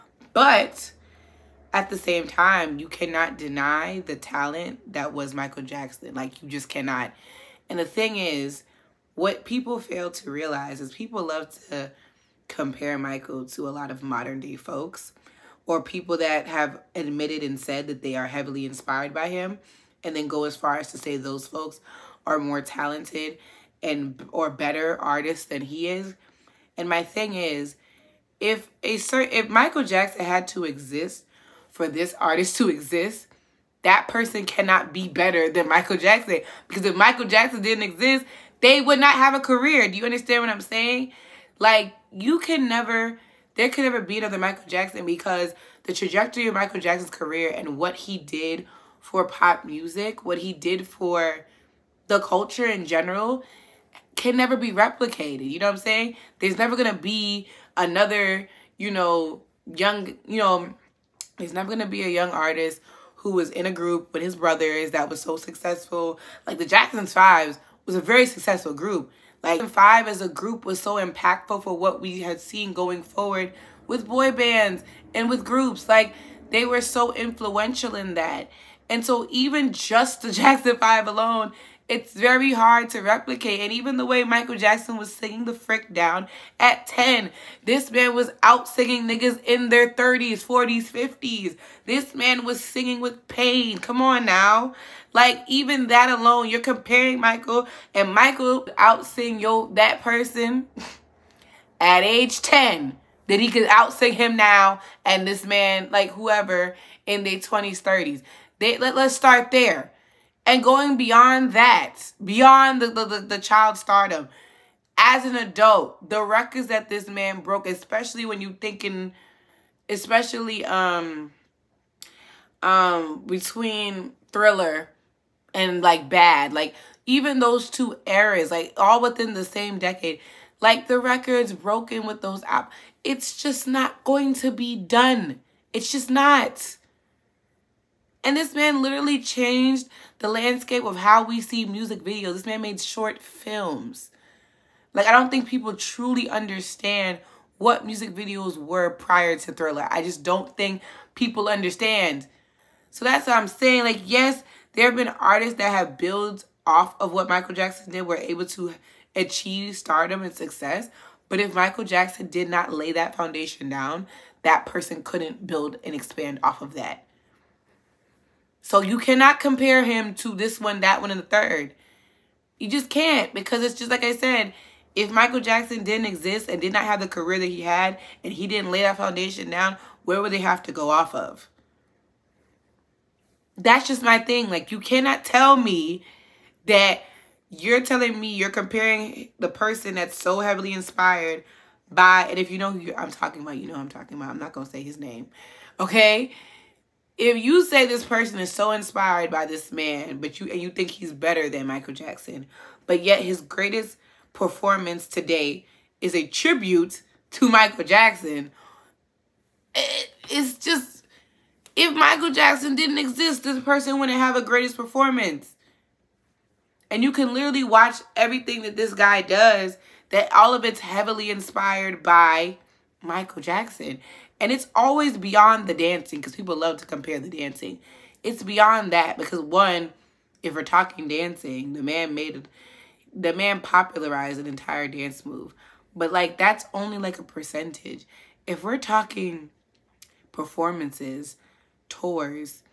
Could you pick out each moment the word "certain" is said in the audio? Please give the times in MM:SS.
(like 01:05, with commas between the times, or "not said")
00:28.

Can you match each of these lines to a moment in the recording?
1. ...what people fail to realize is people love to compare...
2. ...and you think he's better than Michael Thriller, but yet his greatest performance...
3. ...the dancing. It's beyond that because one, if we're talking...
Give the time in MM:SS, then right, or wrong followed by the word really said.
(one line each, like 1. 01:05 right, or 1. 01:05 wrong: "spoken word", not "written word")
1. 00:09 right
2. 03:20 wrong: "Jackson", not "Thriller"
3. 03:47 right.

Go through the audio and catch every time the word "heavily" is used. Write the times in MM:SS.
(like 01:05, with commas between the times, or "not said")
00:18, 03:10, 03:40.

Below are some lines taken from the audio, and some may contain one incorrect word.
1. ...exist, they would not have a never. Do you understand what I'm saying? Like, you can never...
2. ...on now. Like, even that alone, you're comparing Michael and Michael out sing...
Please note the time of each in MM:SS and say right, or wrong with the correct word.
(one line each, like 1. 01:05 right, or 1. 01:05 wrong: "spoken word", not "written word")
1. 00:37 wrong: "career", not "never"
2. 01:33 right.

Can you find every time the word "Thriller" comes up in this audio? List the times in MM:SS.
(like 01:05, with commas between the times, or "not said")
02:04, 02:29.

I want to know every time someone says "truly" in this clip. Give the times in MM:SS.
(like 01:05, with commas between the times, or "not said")
02:25.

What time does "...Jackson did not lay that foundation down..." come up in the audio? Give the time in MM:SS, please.
02:41.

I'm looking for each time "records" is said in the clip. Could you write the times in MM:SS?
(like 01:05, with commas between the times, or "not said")
01:56, 02:10.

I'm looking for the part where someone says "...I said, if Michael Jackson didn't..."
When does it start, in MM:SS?
02:54.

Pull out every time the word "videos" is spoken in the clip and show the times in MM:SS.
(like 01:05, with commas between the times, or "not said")
02:22, 02:28.